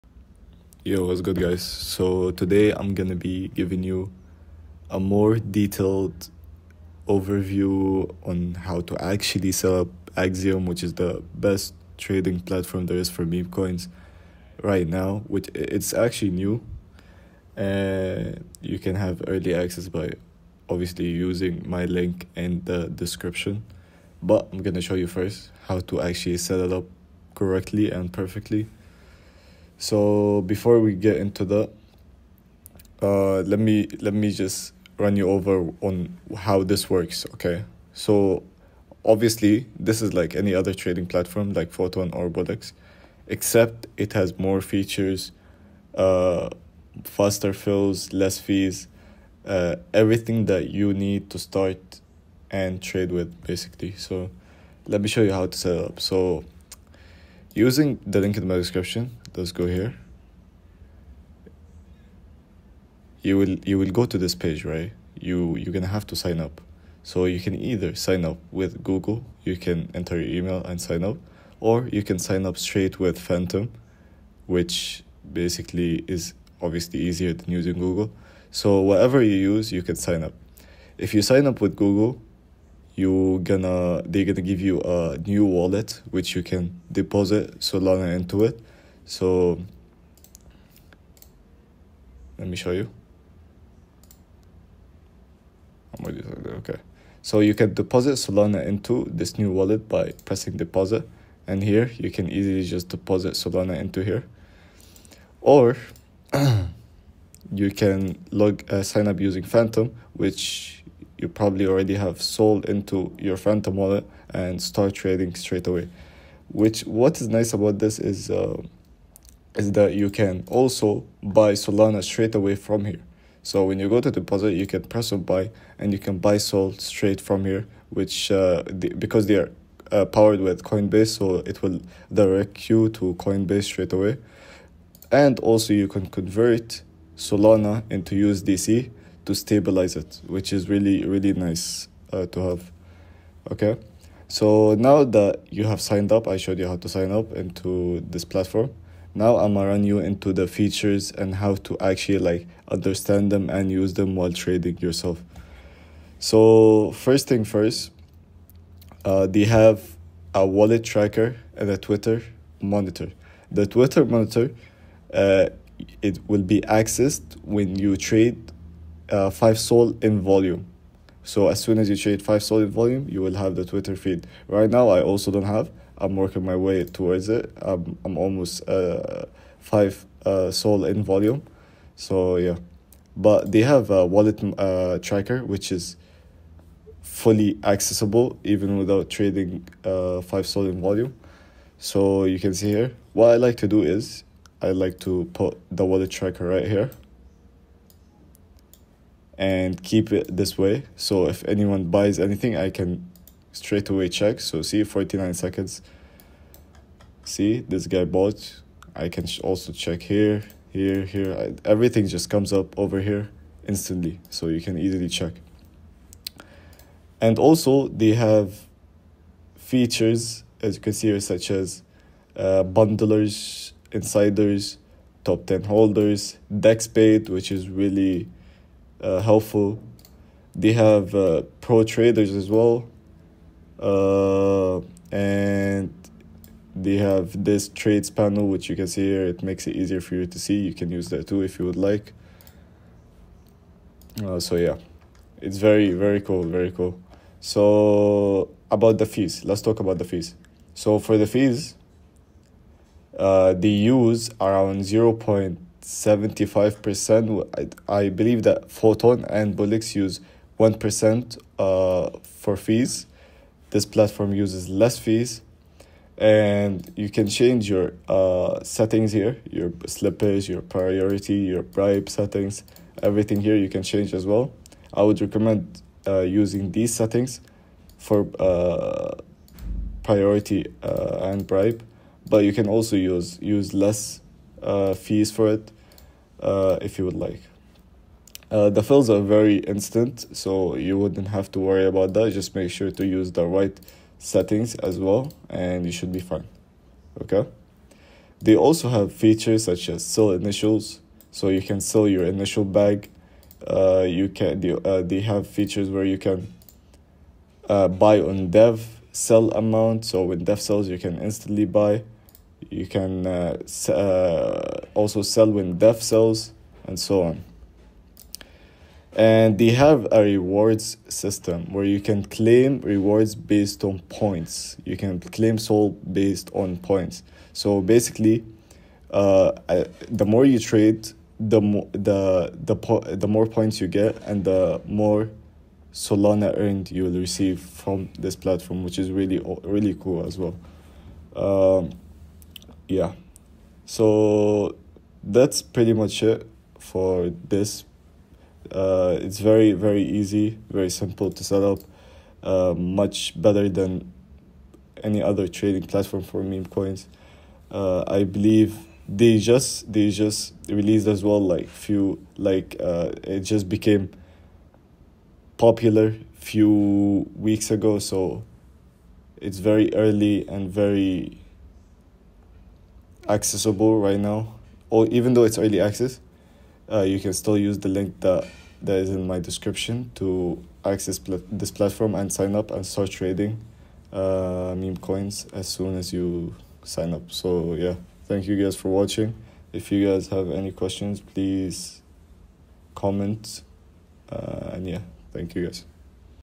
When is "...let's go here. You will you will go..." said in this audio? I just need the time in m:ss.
0:59.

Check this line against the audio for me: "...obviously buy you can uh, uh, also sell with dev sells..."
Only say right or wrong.
wrong.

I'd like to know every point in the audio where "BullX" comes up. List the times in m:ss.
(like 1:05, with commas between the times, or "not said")
0:42, 4:19.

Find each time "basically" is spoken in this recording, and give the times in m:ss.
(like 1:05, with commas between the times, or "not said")
0:53, 1:15, 5:27.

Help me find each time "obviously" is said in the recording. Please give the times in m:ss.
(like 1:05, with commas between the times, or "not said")
0:20, 0:39, 1:16.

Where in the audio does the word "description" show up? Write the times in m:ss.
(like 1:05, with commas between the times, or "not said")
0:22, 0:58, 6:19.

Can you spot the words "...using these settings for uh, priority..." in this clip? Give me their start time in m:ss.
4:36.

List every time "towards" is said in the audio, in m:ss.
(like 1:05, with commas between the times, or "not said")
2:56.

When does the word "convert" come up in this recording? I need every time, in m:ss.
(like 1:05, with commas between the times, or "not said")
2:16.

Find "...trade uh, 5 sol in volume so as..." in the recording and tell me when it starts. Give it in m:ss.
2:47.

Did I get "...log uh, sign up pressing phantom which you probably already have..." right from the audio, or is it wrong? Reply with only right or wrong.
wrong.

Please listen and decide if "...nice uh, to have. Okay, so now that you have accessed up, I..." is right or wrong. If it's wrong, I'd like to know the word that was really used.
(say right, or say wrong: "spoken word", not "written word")
wrong: "signed", not "accessed".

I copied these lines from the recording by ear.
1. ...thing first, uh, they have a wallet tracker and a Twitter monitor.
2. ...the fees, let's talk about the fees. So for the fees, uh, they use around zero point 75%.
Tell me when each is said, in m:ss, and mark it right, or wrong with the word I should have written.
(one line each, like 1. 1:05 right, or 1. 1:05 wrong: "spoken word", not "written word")
1. 2:37 right
2. 4:08 right.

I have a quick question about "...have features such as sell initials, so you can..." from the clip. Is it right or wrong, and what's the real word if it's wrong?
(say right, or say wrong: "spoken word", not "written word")
right.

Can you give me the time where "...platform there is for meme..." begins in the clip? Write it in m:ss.
0:12.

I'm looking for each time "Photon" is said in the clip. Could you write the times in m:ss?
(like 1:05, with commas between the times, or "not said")
0:41, 4:18.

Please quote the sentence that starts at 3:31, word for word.
I, everything just comes up over here instantly.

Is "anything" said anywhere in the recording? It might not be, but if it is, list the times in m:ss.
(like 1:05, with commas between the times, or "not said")
3:22.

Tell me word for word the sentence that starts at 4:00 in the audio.
You can use that too if you would like.